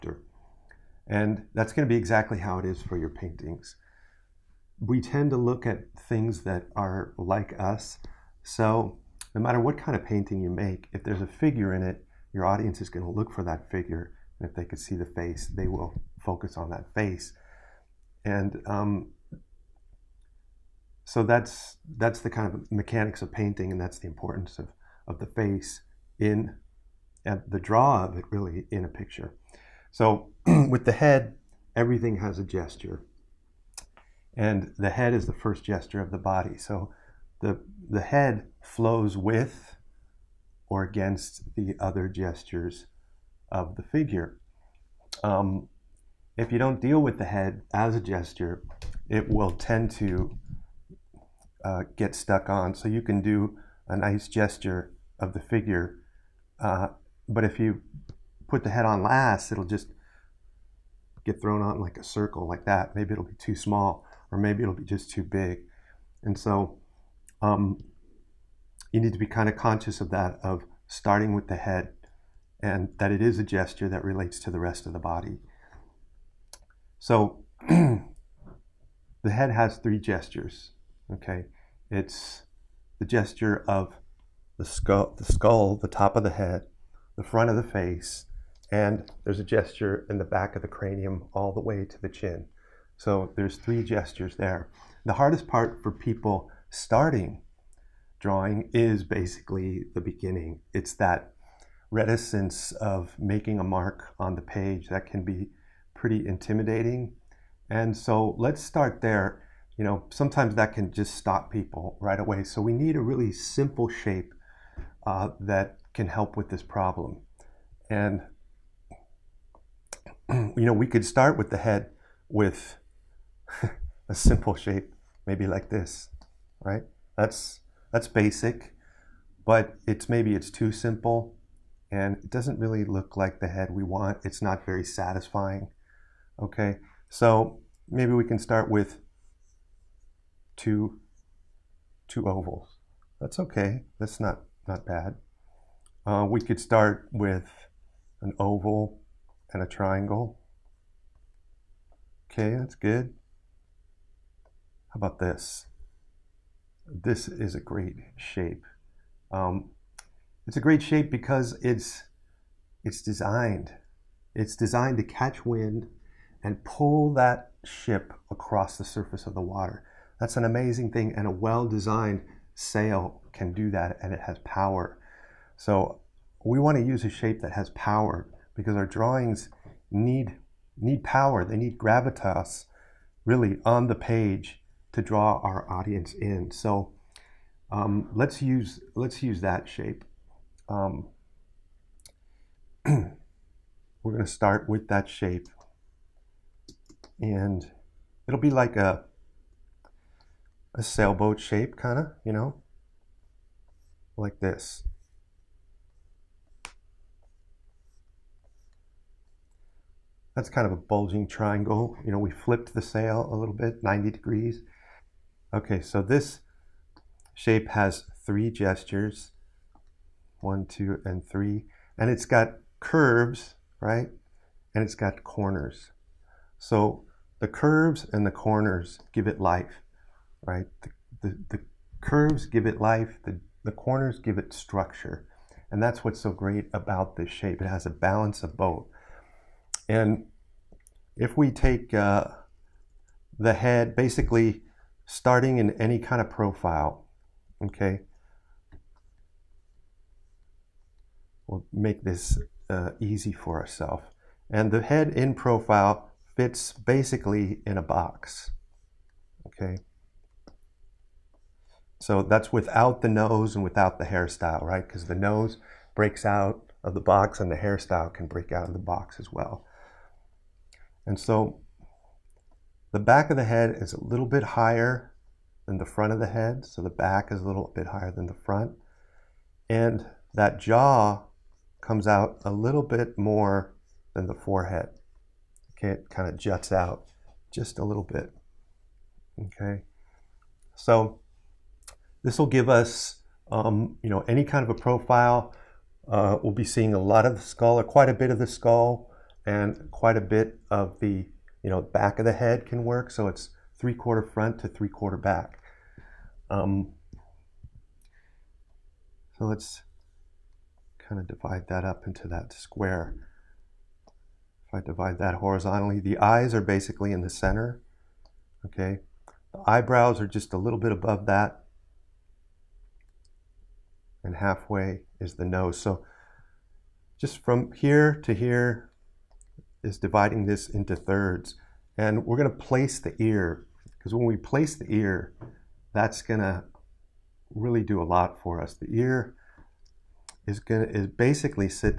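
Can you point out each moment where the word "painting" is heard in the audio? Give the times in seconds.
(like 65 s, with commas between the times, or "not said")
3 s, 10 s, 23 s.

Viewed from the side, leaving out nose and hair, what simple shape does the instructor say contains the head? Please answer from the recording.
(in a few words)
A box.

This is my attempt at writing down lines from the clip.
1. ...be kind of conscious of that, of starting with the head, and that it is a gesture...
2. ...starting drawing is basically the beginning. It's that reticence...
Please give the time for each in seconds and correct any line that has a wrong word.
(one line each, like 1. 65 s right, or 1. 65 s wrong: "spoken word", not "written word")
1. 69 s right
2. 96 s right.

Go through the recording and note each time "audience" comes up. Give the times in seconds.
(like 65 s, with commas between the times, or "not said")
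12 s, 185 s.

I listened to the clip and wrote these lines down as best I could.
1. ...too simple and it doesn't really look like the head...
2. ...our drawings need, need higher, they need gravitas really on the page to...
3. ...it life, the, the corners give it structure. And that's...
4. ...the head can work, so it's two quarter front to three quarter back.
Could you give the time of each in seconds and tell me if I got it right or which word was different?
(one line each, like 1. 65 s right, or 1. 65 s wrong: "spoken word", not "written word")
1. 130 s right
2. 178 s wrong: "power", not "higher"
3. 232 s right
4. 302 s wrong: "three", not "two".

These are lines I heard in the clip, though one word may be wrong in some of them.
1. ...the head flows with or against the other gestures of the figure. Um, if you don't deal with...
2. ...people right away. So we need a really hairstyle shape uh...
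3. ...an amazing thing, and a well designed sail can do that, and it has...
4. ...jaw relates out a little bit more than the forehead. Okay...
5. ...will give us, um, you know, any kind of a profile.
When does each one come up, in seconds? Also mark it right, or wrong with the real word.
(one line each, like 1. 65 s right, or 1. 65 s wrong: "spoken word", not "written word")
1. 37 s right
2. 111 s wrong: "simple", not "hairstyle"
3. 170 s right
4. 280 s wrong: "comes", not "relates"
5. 292 s right.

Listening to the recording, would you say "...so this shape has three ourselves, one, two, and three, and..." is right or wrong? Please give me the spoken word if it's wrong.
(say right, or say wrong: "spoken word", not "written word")
wrong: "gestures", not "ourselves".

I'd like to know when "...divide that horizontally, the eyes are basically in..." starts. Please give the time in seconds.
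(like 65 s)
314 s.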